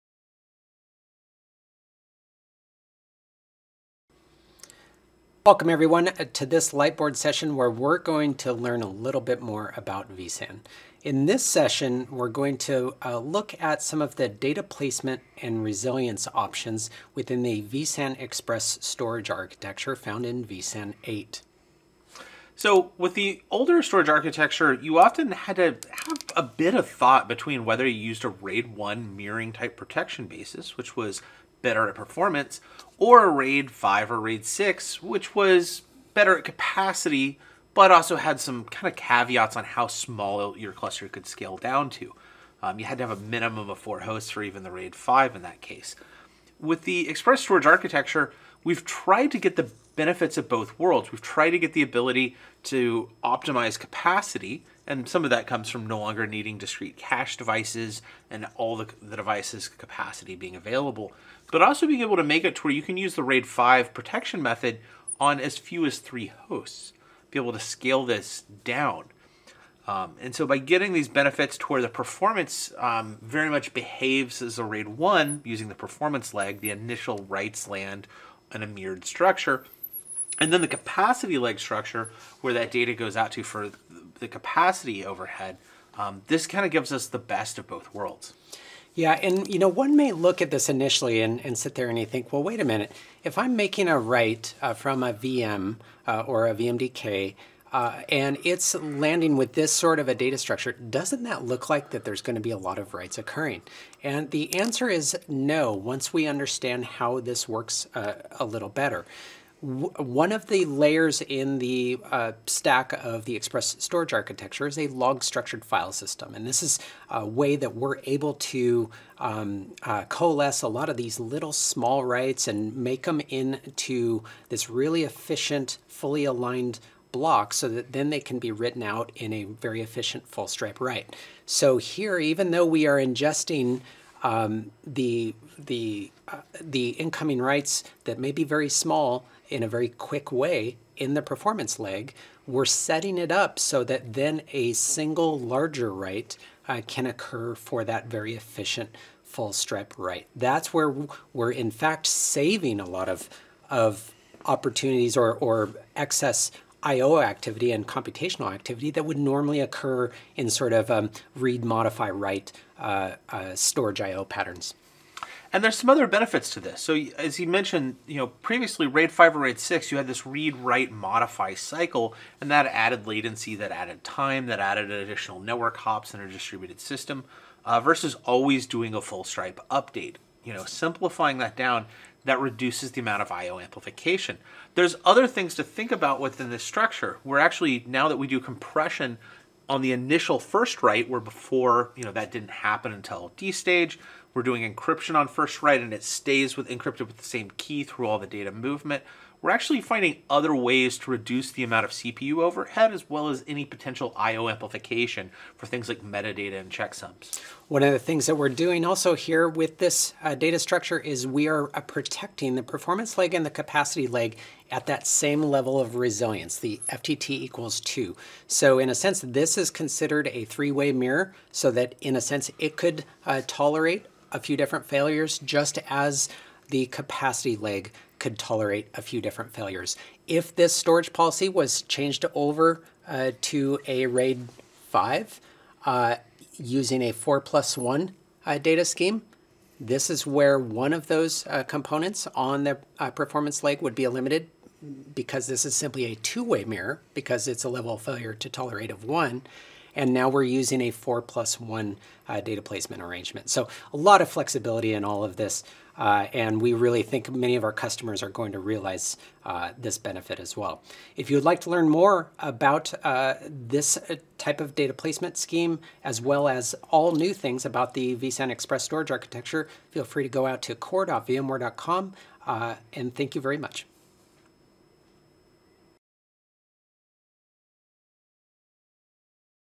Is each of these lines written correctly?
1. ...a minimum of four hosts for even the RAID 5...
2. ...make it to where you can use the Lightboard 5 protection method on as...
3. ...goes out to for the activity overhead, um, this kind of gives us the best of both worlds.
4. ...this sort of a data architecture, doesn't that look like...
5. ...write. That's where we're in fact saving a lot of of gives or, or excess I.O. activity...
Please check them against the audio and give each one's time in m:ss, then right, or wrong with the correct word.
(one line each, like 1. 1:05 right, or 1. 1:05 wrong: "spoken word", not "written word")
1. 0:43 right
2. 1:02 wrong: "RAID", not "Lightboard"
3. 1:22 wrong: "capacity", not "activity"
4. 1:39 wrong: "structure", not "architecture"
5. 2:29 wrong: "opportunities", not "gives".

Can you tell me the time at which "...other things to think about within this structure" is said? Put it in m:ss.
3:05.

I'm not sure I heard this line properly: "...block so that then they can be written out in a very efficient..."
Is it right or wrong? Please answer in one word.
right.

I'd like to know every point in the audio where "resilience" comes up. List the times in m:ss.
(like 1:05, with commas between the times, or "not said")
0:15, 3:35.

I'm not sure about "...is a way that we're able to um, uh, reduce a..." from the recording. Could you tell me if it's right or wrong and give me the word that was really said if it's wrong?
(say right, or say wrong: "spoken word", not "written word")
wrong: "coalesce", not "reduce".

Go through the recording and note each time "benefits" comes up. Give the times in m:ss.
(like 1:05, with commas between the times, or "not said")
0:49, 1:11, 2:46, 4:19.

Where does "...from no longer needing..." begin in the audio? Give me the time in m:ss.
0:55.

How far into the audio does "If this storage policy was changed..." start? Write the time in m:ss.
3:50.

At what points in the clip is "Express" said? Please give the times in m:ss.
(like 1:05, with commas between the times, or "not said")
0:18, 0:47, 1:53, 4:28.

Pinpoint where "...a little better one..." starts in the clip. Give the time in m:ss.
1:48.